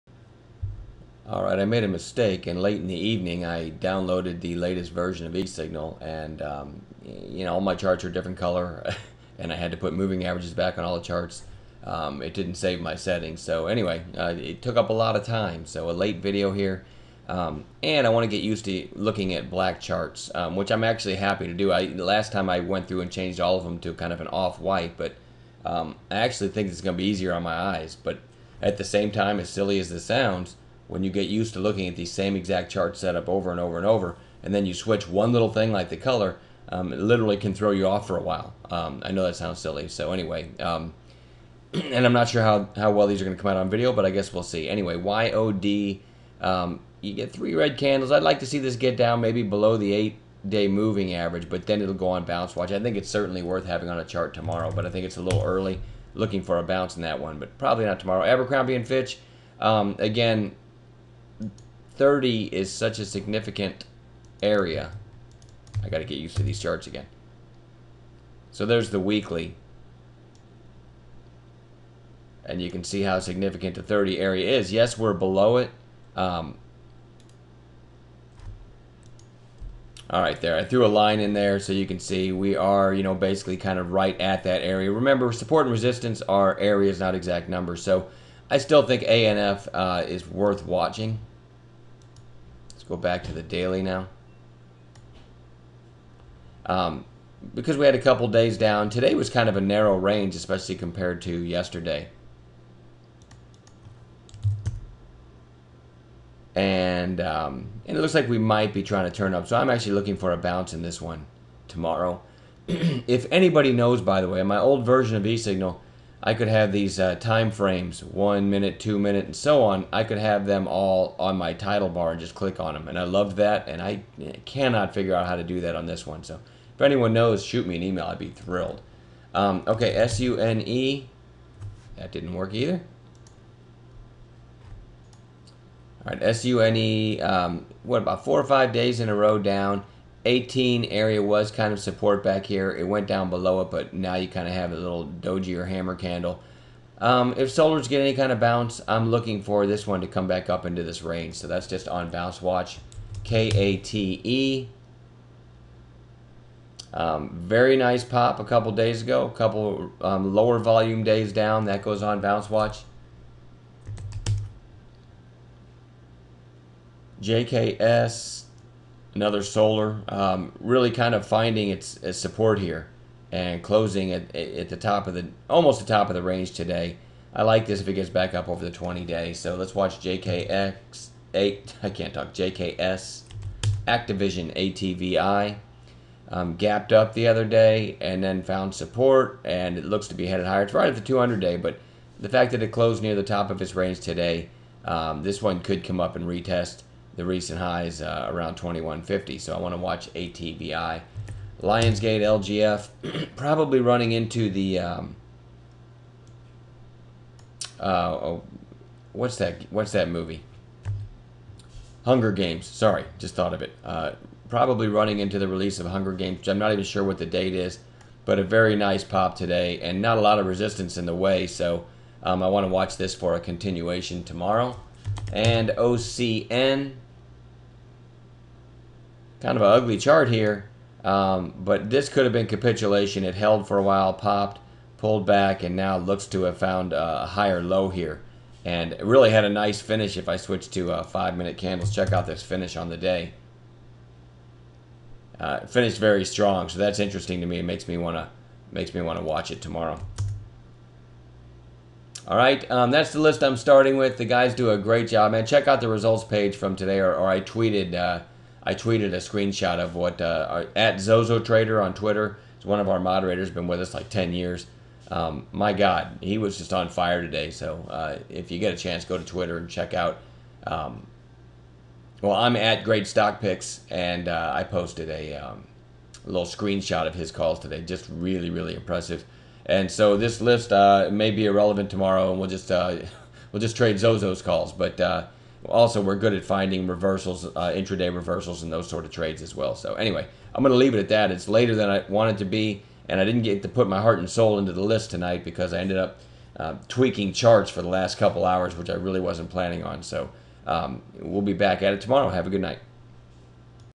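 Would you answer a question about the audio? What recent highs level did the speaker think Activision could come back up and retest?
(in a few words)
2150.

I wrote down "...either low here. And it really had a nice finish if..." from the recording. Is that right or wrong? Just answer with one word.
wrong.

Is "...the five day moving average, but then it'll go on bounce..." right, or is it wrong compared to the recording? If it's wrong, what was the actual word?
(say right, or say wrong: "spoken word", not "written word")
wrong: "eight", not "five".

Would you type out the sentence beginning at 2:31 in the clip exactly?
So that's just on bounce watch.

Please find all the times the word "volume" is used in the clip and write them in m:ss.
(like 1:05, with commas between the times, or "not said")
2:40.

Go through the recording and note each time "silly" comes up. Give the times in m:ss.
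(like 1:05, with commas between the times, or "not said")
0:29, 0:39.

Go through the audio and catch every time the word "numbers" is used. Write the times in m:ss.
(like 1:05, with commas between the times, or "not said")
1:27.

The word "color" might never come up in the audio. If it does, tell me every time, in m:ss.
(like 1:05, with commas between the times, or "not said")
0:08, 0:35.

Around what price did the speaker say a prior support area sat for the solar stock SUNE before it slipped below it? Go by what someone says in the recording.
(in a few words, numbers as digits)
18.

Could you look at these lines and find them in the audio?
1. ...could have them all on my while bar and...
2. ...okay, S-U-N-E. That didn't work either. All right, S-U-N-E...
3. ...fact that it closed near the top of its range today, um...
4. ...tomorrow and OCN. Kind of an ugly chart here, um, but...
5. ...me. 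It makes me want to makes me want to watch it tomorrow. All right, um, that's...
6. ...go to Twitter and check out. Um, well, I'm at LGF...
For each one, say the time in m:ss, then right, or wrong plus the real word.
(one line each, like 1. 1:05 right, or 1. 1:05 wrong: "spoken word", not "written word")
1. 2:00 wrong: "title", not "while"
2. 2:09 right
3. 3:12 right
4. 3:44 right
5. 4:07 right
6. 4:29 wrong: "Great", not "LGF".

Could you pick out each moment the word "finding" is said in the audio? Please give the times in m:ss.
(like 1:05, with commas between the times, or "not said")
2:51, 4:46.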